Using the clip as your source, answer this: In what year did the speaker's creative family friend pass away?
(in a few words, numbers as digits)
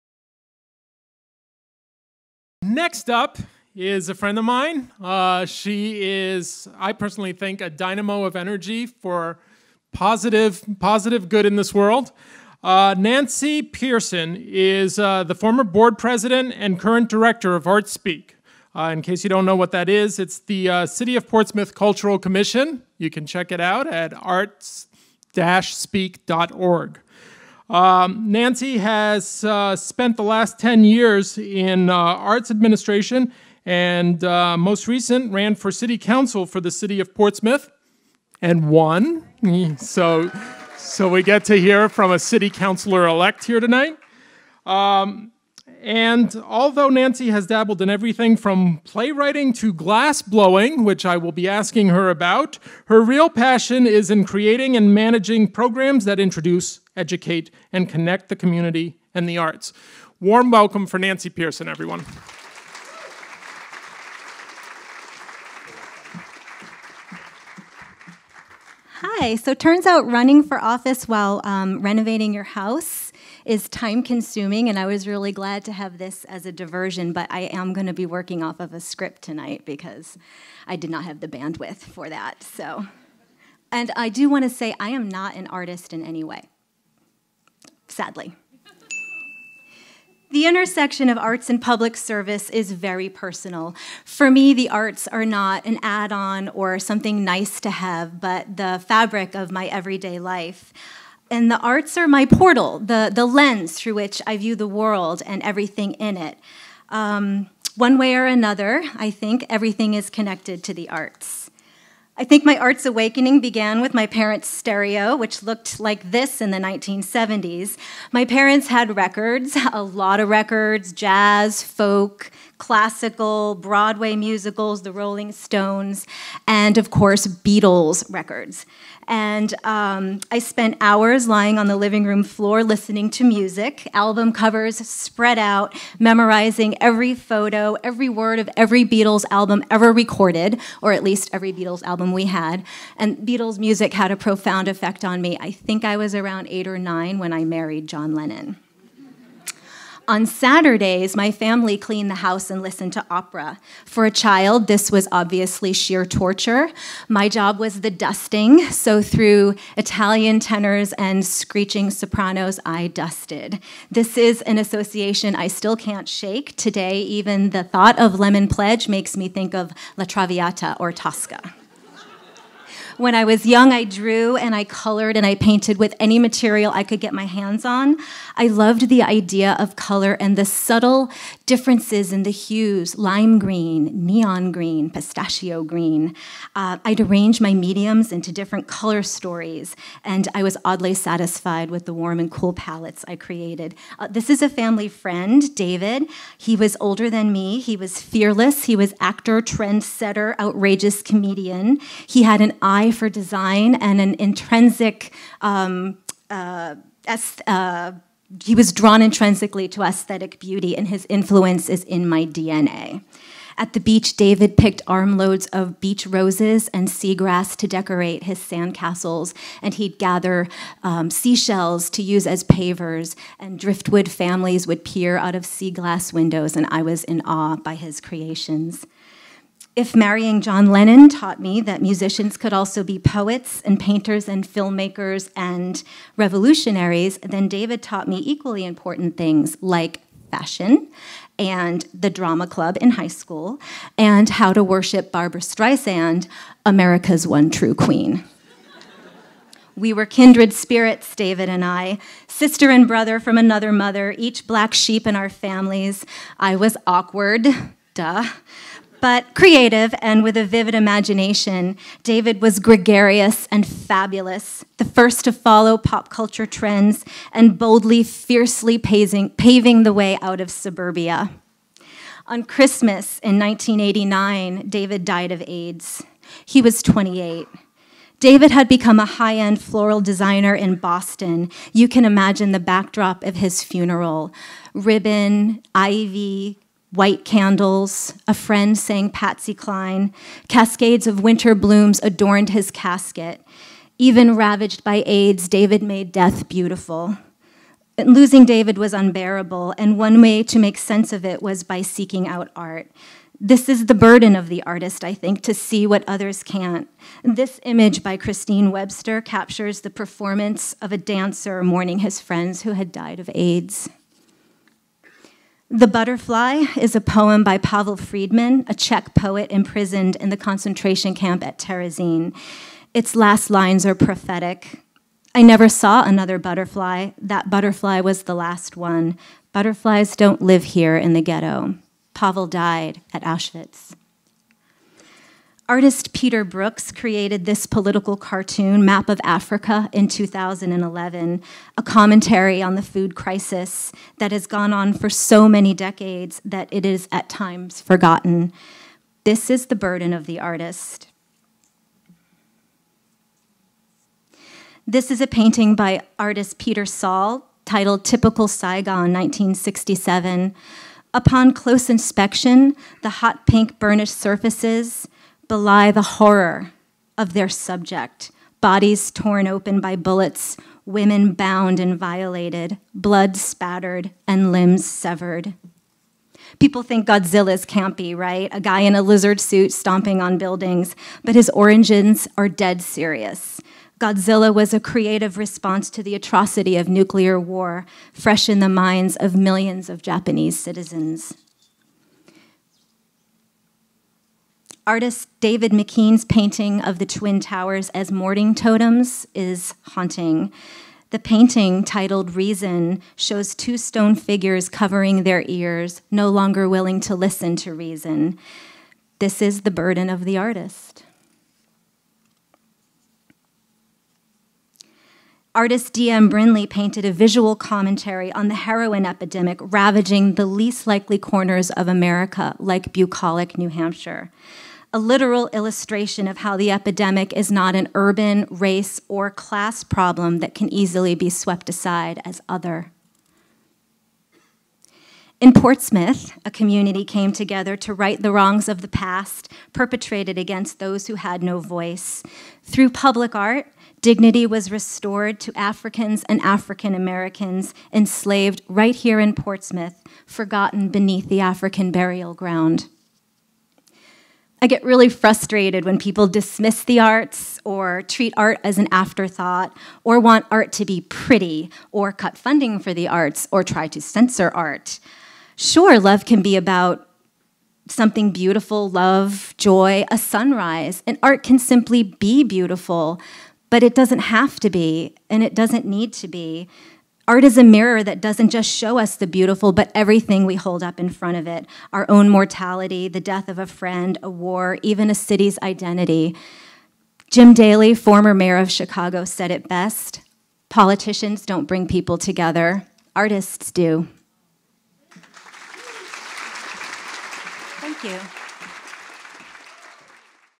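1989.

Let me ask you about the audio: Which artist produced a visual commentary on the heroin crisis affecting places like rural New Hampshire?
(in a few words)
D.M. Brinley.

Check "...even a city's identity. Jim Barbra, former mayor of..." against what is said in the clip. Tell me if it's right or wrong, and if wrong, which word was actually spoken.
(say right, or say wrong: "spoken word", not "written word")
wrong: "Daly", not "Barbra".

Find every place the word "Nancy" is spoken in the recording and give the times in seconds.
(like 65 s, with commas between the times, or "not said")
12 s, 28 s, 46 s, 60 s.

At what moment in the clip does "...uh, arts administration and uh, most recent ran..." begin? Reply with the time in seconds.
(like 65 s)
31 s.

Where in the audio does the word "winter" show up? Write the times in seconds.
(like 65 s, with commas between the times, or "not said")
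291 s.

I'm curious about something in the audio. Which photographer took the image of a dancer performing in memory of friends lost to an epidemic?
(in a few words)
Christine Webster.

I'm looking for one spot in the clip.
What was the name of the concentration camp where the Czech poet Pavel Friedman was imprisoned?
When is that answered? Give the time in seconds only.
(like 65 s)
321 s.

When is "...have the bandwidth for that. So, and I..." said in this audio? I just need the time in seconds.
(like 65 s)
81 s.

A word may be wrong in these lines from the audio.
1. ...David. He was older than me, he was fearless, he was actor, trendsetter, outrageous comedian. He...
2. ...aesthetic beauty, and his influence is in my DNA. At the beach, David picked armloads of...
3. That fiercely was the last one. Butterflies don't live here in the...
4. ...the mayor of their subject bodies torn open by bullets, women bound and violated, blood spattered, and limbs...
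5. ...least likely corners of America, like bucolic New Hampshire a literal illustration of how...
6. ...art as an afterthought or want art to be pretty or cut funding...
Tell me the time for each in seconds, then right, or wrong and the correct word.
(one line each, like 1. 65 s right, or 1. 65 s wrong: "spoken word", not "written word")
1. 195 s right
2. 209 s right
3. 327 s wrong: "butterfly", not "fiercely"
4. 365 s wrong: "horror", not "mayor"
5. 420 s right
6. 458 s right.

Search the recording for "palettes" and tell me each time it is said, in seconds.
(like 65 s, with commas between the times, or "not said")
192 s.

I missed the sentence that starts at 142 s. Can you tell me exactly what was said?
And Beatles music had a profound effect on me.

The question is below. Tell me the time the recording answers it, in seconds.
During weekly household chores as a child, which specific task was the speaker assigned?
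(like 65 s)
157 s.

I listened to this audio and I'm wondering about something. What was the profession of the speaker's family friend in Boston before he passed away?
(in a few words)
floral designer.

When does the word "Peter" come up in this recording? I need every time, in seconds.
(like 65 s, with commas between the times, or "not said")
336 s, 356 s.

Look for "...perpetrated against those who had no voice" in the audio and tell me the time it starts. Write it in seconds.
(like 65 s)
439 s.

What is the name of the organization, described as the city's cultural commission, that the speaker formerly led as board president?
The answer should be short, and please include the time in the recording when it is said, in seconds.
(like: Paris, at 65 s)
ArtSpeak, at 17 s.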